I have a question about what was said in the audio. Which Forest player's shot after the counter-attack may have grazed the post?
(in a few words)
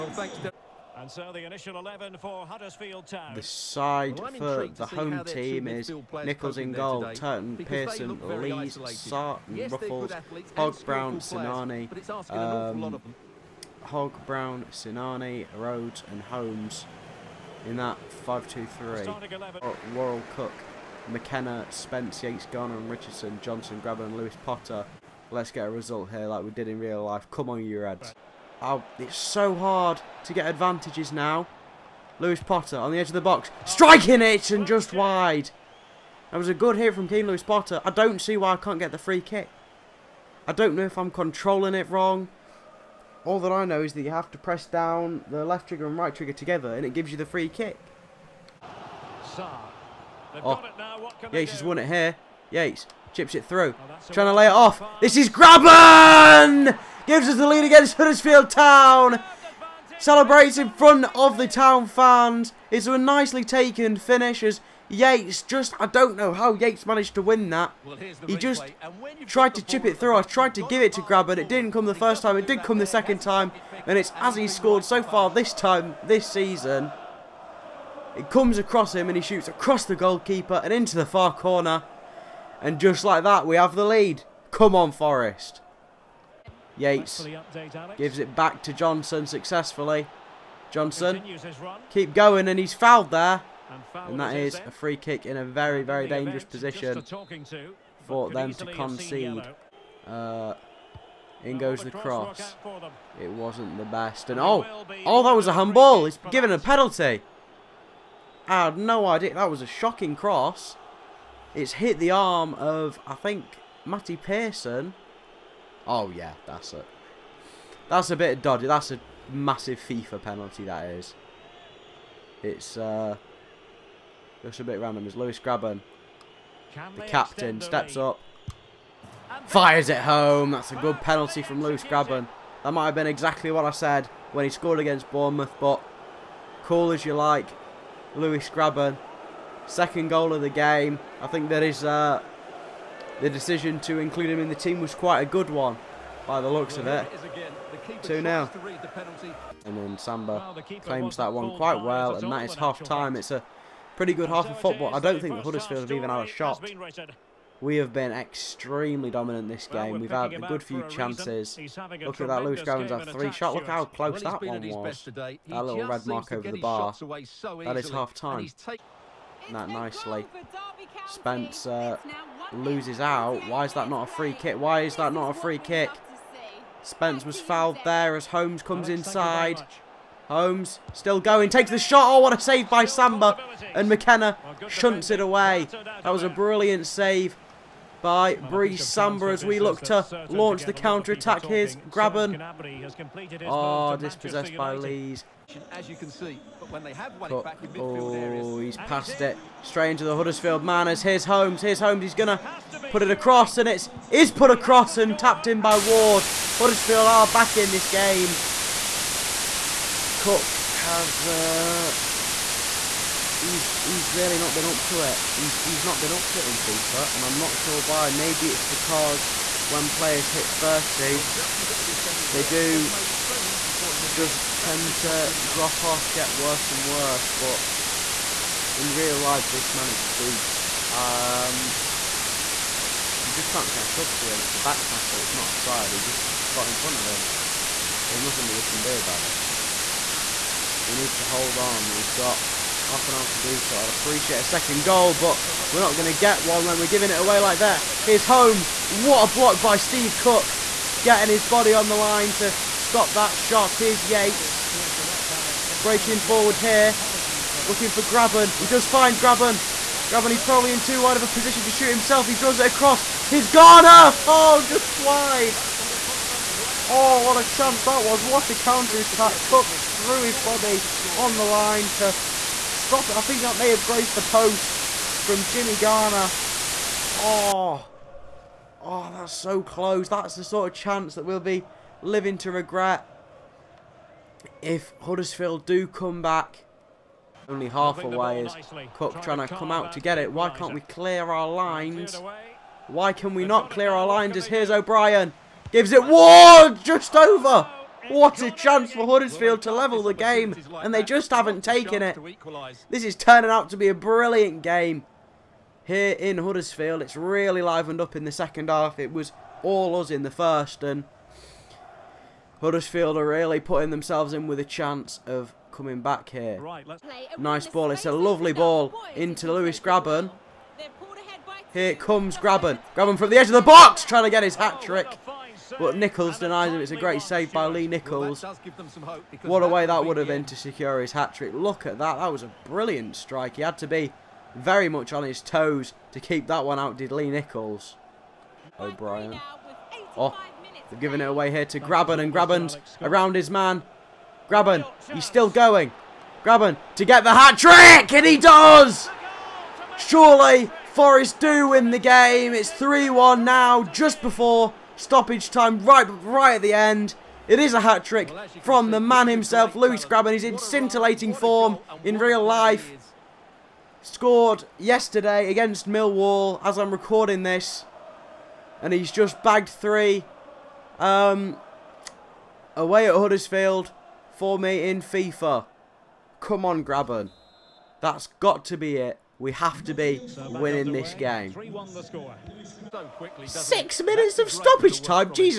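Jimmy Garner.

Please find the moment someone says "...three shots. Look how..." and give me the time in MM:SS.
02:43.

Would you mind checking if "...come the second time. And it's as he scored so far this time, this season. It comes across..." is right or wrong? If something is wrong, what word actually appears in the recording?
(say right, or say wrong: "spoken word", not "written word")
right.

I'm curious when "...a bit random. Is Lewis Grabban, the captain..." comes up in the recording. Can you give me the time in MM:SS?
02:04.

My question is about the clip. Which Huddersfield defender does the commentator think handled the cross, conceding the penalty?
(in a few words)
Matty Pearson.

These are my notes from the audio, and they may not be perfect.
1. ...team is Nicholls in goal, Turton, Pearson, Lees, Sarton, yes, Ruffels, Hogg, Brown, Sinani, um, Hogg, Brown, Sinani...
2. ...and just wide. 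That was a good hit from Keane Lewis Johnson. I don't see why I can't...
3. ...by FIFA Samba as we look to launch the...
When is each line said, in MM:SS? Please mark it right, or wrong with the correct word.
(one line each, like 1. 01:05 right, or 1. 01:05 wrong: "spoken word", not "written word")
1. 00:05 right
2. 00:34 wrong: "Potter", not "Johnson"
3. 03:08 wrong: "Brice", not "FIFA".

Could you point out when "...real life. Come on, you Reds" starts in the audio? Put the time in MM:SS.
00:26.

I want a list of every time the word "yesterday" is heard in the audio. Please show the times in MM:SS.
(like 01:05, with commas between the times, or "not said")
06:04.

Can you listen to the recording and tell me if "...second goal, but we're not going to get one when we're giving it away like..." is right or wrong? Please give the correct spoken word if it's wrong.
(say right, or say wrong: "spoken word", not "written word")
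right.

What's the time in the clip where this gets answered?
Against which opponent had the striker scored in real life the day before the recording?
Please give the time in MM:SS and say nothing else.
06:05.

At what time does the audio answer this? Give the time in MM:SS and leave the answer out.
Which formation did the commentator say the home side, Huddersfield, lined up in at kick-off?
00:18.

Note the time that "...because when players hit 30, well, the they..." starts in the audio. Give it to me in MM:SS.
03:38.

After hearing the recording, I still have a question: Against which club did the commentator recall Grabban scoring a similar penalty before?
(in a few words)
Bournemouth.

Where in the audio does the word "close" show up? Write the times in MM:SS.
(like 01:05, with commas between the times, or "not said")
02:43, 04:39.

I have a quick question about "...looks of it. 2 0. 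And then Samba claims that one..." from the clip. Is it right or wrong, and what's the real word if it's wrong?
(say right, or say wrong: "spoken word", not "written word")
right.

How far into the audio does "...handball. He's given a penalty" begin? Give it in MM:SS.
01:45.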